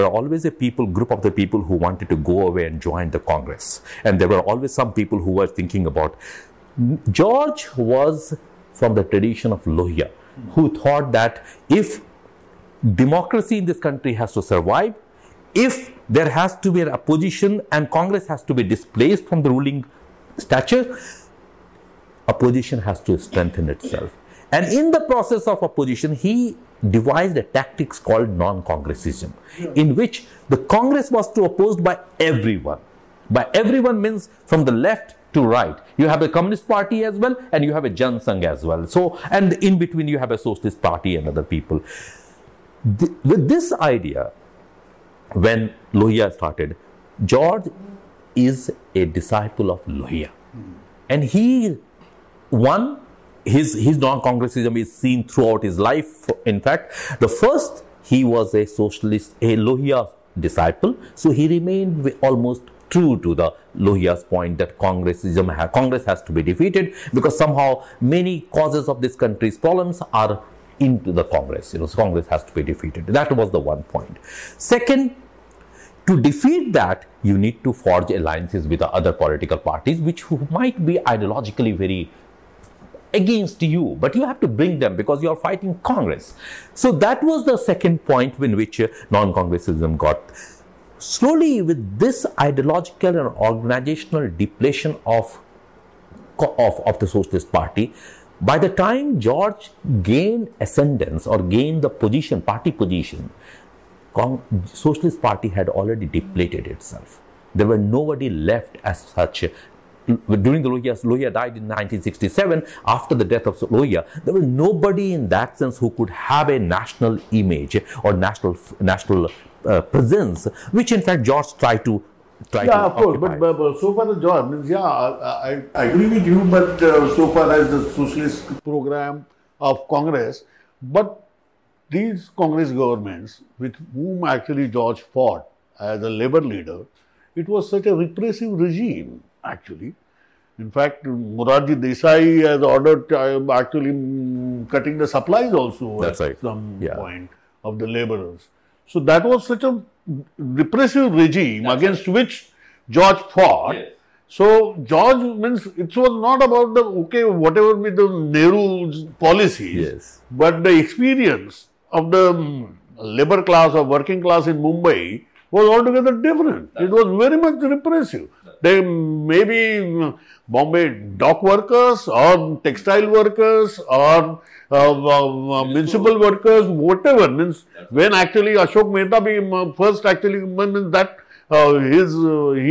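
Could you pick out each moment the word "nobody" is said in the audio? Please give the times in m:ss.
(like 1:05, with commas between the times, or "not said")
1:47, 1:54.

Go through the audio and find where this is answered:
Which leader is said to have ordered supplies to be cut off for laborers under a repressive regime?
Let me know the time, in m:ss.
2:21.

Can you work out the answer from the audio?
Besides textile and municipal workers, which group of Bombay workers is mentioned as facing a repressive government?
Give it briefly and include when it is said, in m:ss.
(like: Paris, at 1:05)
dock workers, at 2:50.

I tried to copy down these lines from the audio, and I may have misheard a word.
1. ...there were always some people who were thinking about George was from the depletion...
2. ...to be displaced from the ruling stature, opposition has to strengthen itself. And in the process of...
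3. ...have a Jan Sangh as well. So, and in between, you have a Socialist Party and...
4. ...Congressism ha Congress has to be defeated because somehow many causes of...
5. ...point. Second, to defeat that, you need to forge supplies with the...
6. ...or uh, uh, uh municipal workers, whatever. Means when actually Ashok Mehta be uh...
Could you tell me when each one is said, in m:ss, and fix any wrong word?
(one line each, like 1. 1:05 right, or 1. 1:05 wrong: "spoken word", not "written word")
1. 0:04 wrong: "tradition", not "depletion"
2. 0:18 right
3. 0:37 right
4. 1:04 right
5. 1:13 wrong: "alliances", not "supplies"
6. 2:53 right.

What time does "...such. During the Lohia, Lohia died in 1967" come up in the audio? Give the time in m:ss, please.
1:49.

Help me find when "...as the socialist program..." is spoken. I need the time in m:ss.
2:07.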